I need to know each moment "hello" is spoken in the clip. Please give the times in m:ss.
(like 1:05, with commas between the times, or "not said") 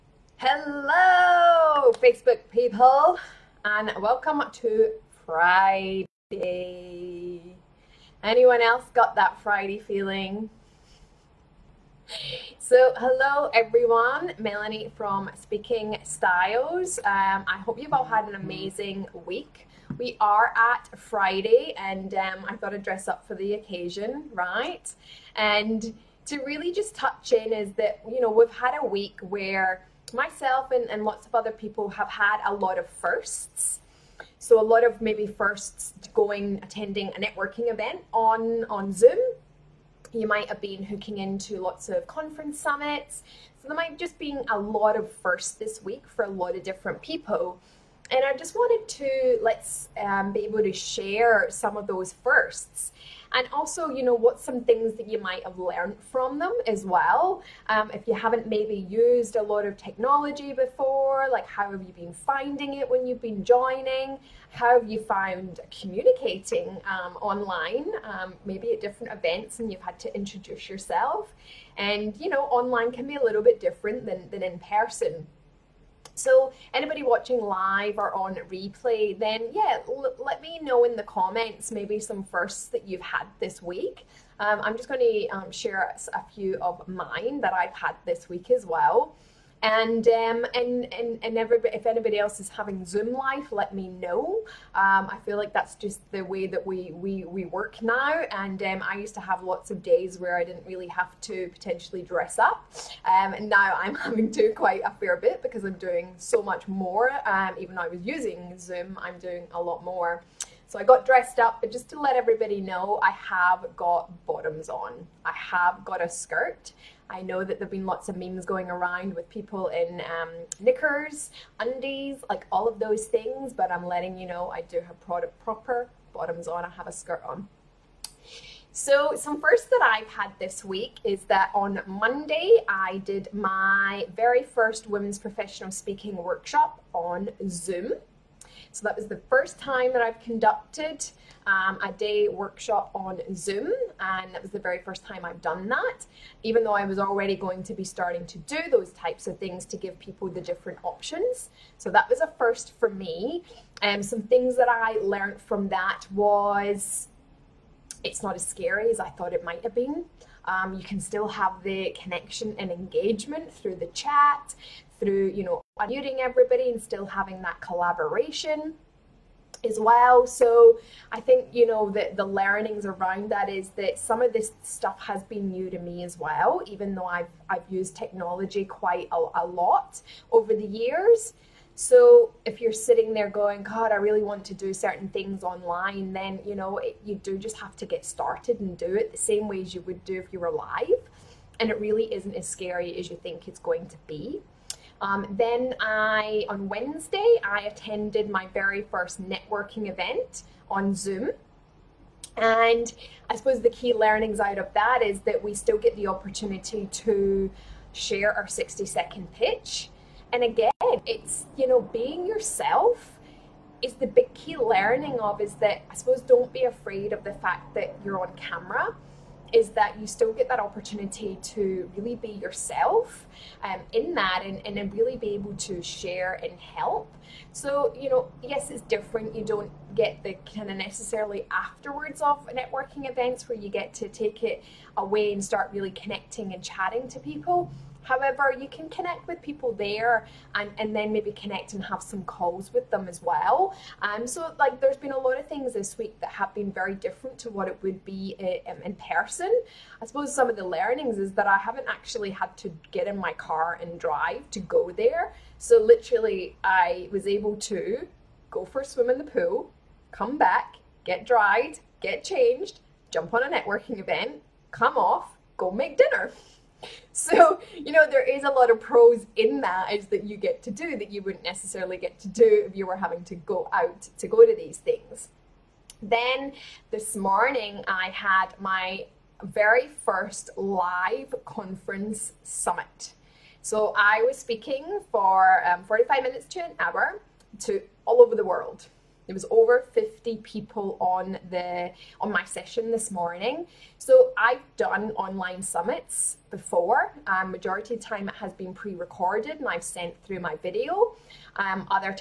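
0:00, 0:12.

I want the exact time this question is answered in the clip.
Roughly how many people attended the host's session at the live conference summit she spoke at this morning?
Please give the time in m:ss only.
4:49.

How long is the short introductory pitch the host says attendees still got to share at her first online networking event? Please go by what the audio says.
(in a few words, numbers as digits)
60 seconds.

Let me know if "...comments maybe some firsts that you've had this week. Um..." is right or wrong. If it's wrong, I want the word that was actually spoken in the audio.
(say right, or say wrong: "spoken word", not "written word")
right.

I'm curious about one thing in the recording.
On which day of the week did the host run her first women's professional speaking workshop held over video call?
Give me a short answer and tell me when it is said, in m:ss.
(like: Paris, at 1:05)
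Monday, at 2:11.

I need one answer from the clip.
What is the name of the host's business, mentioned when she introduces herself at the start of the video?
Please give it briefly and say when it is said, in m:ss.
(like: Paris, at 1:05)
Speaking Styles, at 0:15.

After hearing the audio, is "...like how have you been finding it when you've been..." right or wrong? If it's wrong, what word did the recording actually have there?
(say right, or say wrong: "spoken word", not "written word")
right.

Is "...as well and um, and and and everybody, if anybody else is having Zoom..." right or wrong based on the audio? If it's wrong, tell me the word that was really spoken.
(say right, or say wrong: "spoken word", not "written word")
right.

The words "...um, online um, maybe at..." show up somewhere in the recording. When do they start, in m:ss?
1:06.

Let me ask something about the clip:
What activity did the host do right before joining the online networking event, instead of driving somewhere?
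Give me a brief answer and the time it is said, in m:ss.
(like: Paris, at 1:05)
A swim, at 4:18.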